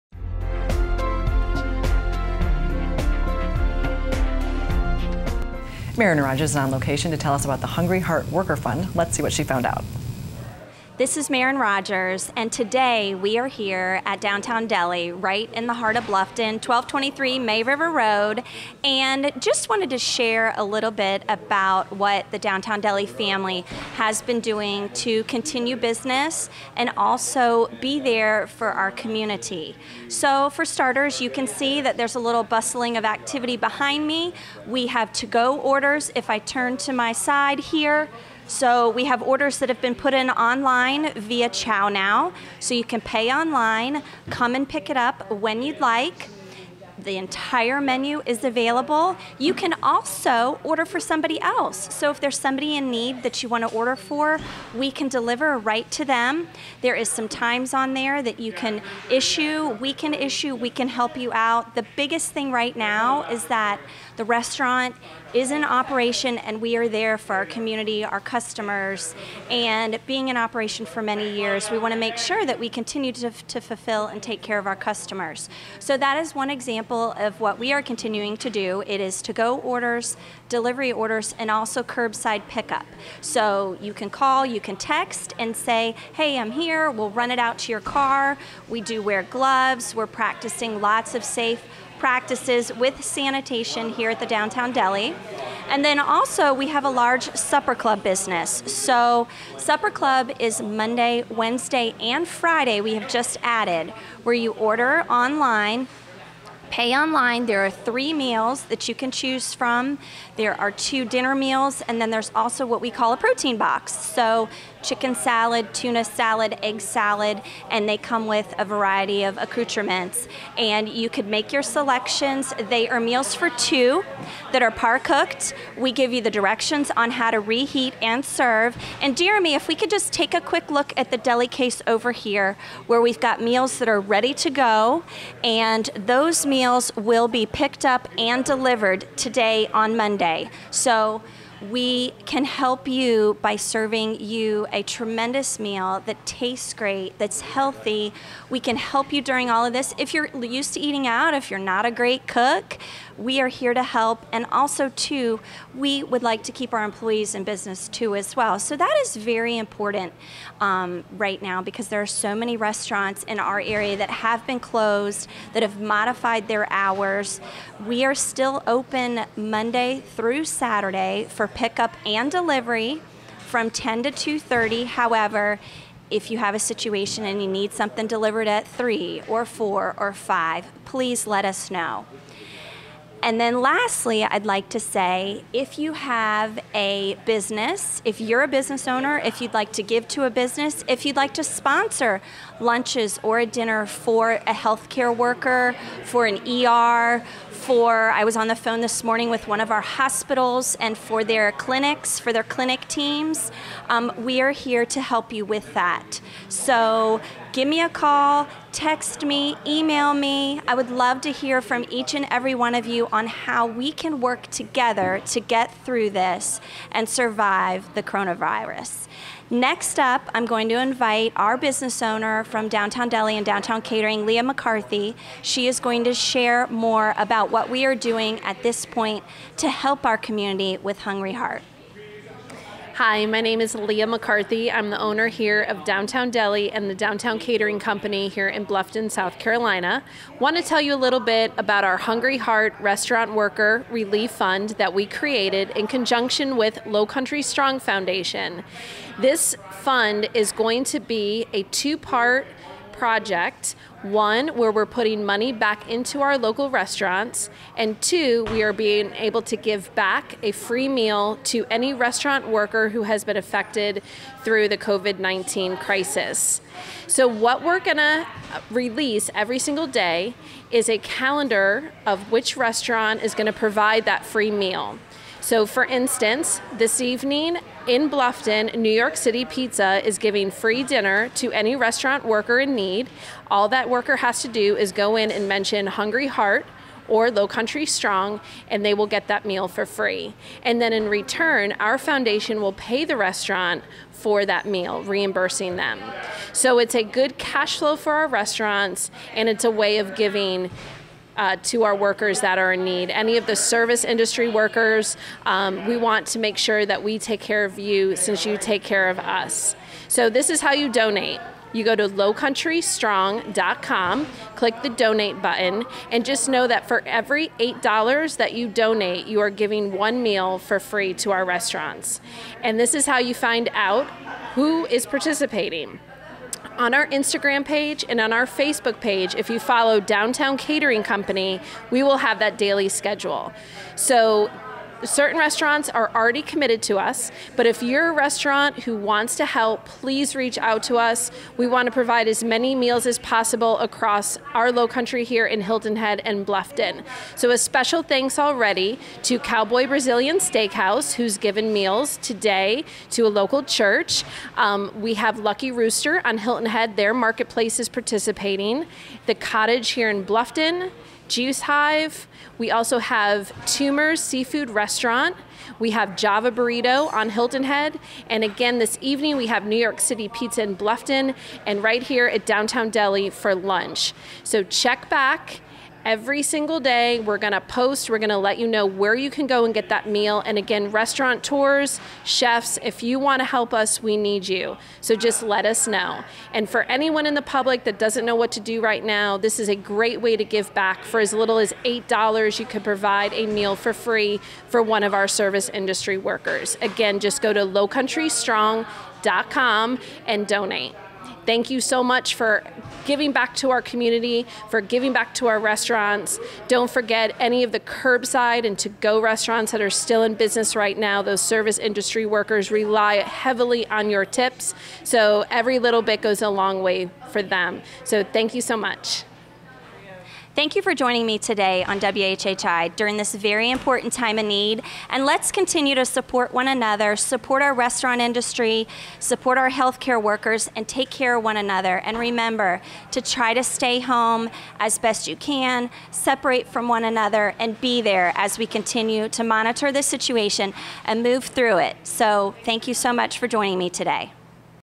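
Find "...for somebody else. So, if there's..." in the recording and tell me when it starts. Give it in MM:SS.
00:50.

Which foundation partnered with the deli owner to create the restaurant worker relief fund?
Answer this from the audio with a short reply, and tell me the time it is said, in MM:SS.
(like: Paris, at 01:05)
Lowcountry Strong Foundation, at 04:06.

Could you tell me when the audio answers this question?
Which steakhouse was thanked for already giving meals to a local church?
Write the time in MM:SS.
05:49.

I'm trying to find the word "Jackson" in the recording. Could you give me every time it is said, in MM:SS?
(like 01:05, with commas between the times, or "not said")
not said.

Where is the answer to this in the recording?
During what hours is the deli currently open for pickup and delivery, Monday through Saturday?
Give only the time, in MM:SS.
02:53.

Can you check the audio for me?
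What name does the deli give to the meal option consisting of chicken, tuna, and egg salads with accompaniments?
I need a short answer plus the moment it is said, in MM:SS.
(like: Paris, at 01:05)
protein box, at 01:53.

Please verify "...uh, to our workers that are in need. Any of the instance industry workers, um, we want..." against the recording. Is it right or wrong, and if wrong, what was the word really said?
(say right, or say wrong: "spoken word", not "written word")
wrong: "service", not "instance".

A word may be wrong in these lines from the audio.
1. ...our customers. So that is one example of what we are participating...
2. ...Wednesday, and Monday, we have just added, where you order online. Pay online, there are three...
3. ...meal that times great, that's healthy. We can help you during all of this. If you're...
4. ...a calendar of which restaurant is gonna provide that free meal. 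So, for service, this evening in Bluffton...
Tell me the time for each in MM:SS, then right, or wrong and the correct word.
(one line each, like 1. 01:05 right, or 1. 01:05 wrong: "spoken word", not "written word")
1. 01:14 wrong: "continuing", not "participating"
2. 01:41 wrong: "Friday", not "Monday"
3. 02:25 wrong: "tastes", not "times"
4. 04:30 wrong: "instance", not "service".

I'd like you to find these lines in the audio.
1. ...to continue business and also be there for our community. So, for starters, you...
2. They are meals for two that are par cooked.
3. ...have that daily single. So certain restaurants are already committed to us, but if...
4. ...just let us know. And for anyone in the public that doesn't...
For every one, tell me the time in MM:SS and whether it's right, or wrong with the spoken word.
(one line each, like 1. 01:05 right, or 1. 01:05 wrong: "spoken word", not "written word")
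1. 00:24 right
2. 02:02 right
3. 05:32 wrong: "schedule", not "single"
4. 06:25 right.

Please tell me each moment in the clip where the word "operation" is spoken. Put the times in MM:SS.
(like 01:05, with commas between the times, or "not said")
01:05, 01:10.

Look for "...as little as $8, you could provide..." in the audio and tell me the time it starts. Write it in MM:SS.
06:31.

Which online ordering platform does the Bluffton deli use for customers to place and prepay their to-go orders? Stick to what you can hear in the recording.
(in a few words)
ChowNow.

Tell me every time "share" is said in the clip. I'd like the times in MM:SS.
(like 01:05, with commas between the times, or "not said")
00:19, 03:46.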